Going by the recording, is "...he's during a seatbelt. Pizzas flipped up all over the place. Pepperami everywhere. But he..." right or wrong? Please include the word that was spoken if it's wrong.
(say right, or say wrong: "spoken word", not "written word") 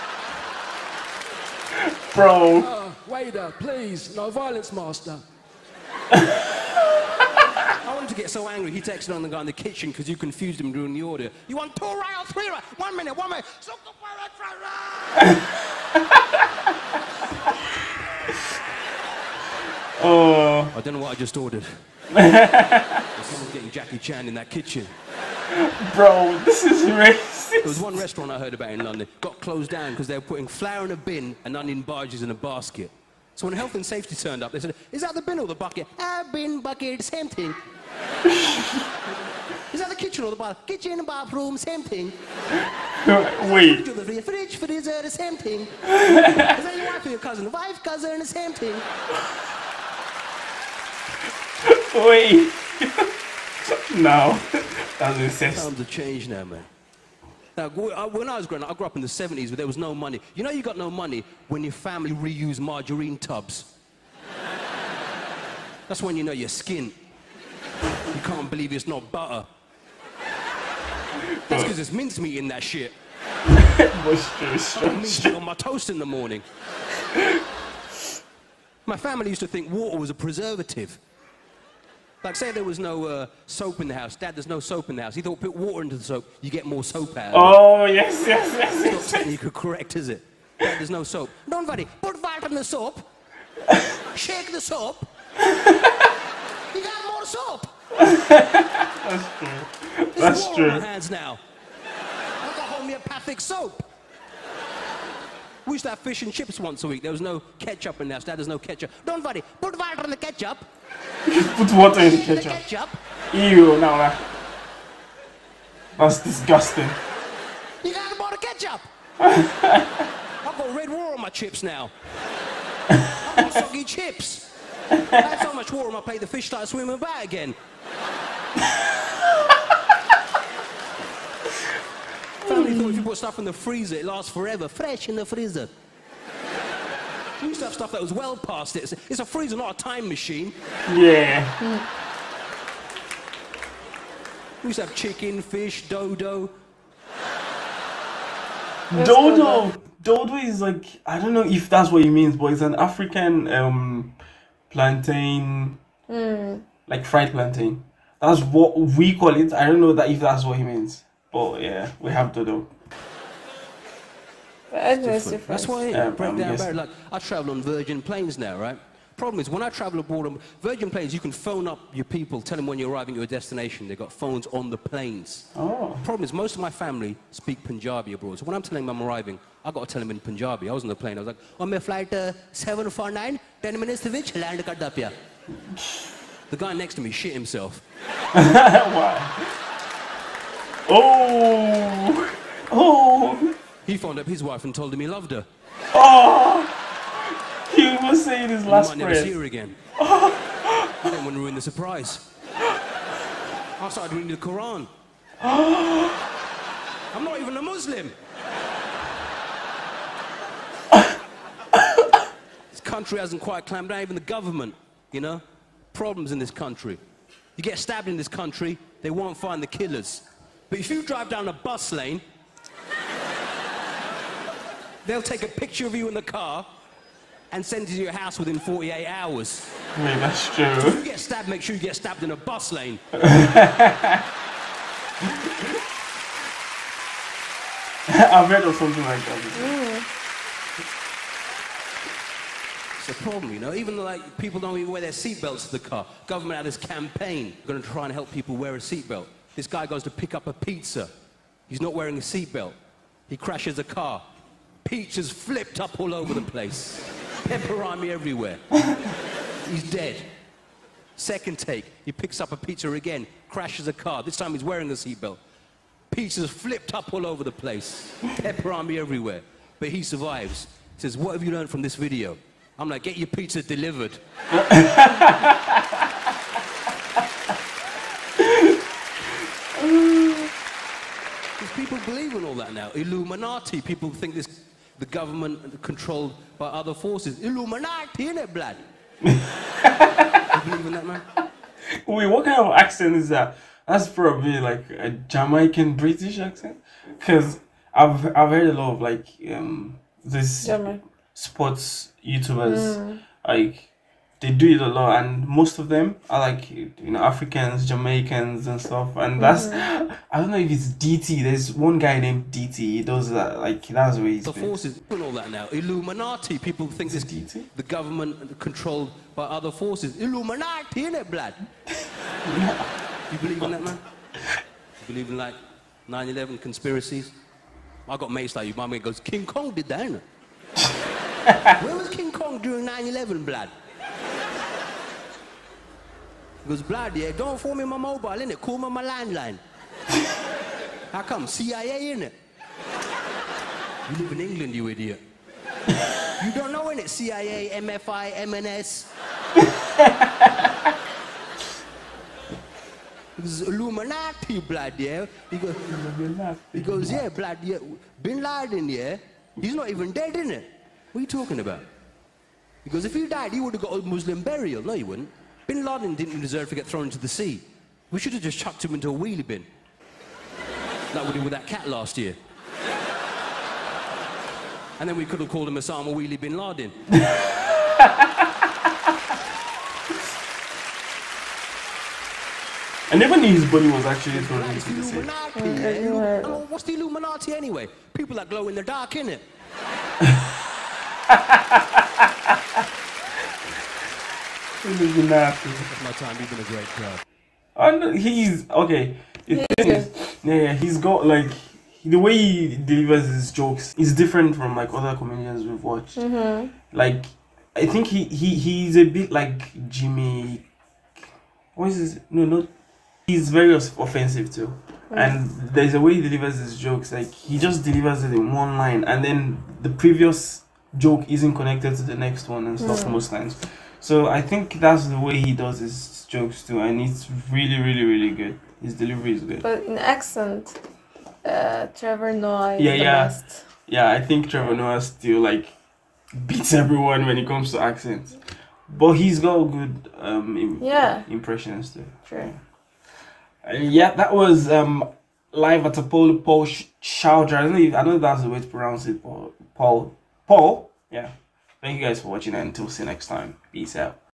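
wrong: "wearing", not "during".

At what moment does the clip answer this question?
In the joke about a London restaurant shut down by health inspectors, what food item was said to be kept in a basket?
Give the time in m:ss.
0:31.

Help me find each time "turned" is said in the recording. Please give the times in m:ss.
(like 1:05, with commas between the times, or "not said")
0:34.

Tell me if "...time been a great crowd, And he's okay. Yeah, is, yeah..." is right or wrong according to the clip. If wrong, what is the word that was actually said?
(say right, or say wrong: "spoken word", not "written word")
right.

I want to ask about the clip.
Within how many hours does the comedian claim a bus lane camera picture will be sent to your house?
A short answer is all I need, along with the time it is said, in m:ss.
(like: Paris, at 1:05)
48, at 3:48.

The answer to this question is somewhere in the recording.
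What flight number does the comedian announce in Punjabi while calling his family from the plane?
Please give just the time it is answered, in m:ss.
3:02.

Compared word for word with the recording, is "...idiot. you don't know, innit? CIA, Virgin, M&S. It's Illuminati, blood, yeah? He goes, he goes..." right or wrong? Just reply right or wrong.
wrong.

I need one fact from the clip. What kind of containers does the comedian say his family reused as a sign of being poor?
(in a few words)
margarine tubs.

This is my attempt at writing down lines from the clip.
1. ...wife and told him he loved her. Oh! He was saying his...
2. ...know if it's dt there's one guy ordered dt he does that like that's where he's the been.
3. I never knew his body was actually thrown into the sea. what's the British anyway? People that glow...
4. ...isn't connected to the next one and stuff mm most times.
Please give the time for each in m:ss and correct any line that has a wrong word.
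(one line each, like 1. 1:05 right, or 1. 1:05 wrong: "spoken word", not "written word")
1. 3:14 right
2. 5:10 wrong: "named", not "ordered"
3. 6:23 wrong: "Illuminati", not "British"
4. 7:01 right.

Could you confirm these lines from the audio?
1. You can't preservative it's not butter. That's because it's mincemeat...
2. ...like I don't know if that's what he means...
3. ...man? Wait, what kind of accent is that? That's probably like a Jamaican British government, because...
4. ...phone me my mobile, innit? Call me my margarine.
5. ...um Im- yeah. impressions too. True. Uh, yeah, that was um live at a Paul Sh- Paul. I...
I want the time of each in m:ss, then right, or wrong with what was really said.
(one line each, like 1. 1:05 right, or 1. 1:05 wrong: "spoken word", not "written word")
1. 1:07 wrong: "believe", not "preservative"
2. 2:30 right
3. 4:51 wrong: "accent", not "government"
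4. 5:37 wrong: "landline", not "margarine"
5. 7:20 wrong: "Chowdhry", not "Paul".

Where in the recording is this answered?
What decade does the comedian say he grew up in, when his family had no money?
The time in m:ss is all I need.
0:59.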